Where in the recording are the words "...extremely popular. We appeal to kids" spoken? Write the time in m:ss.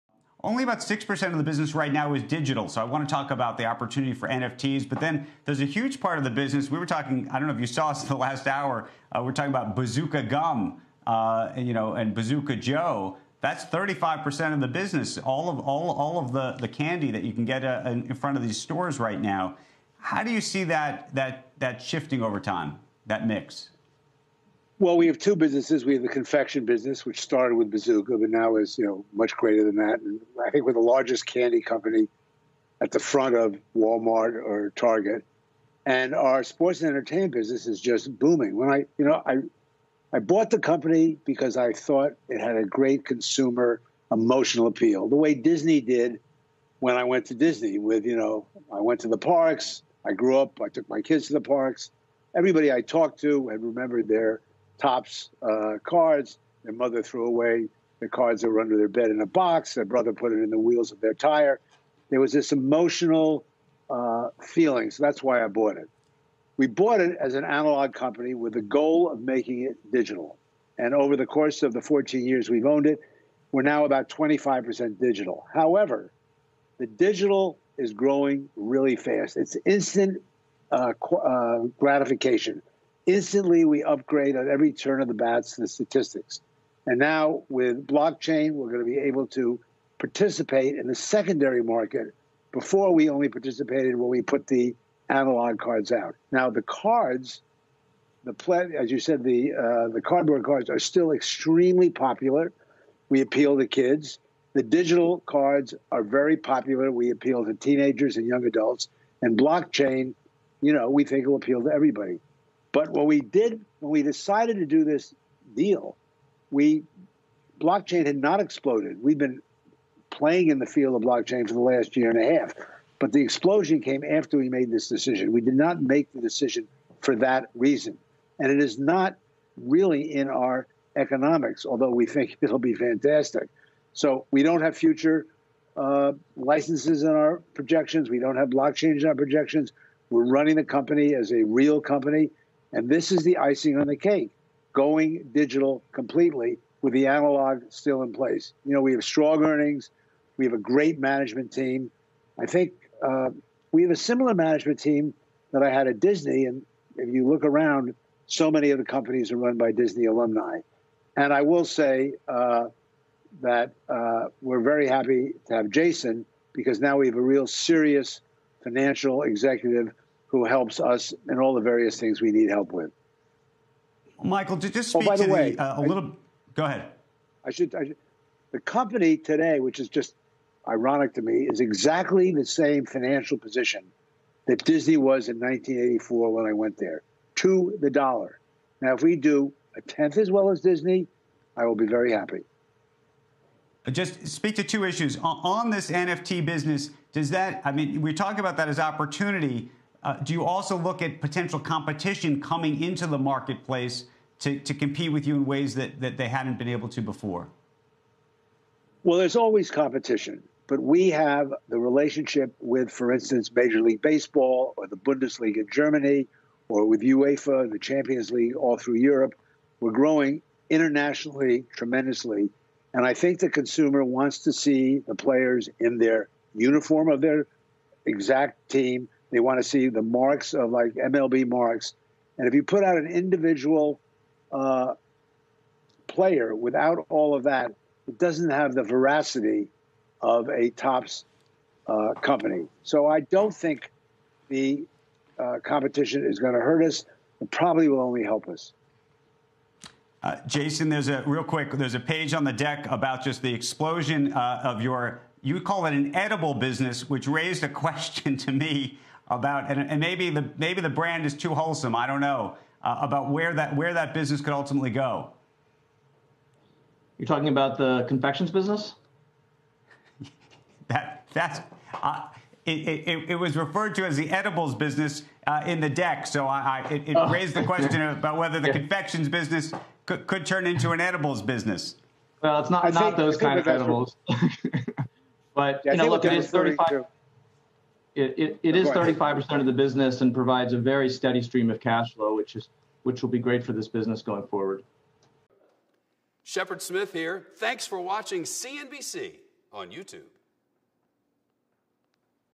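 1:41.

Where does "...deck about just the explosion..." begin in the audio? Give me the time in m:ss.
4:12.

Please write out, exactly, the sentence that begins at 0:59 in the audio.
Their brother put it in the wheels of their tire.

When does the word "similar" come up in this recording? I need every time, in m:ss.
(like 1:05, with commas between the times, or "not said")
2:33.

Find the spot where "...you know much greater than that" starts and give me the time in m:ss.
0:28.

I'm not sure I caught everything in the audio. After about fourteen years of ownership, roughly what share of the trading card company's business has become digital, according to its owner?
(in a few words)
25%.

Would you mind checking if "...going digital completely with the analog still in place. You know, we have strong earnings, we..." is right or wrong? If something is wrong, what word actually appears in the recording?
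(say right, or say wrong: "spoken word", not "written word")
right.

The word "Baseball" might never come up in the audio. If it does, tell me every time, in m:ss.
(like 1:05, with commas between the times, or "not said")
3:34.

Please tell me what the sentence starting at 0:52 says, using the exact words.
Everybody I talked to had remembered their Topps uh, cards.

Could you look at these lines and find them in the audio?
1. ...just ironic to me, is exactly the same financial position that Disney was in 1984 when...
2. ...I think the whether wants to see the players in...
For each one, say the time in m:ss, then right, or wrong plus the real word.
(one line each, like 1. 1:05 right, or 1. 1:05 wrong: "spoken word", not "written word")
1. 2:59 right
2. 3:43 wrong: "consumer", not "whether".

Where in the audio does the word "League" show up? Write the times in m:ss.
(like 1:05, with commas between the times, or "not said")
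3:33, 3:38.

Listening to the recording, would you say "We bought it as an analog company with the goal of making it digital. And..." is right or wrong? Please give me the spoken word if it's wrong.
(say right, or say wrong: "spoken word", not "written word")
right.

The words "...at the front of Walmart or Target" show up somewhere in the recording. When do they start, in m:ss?
0:32.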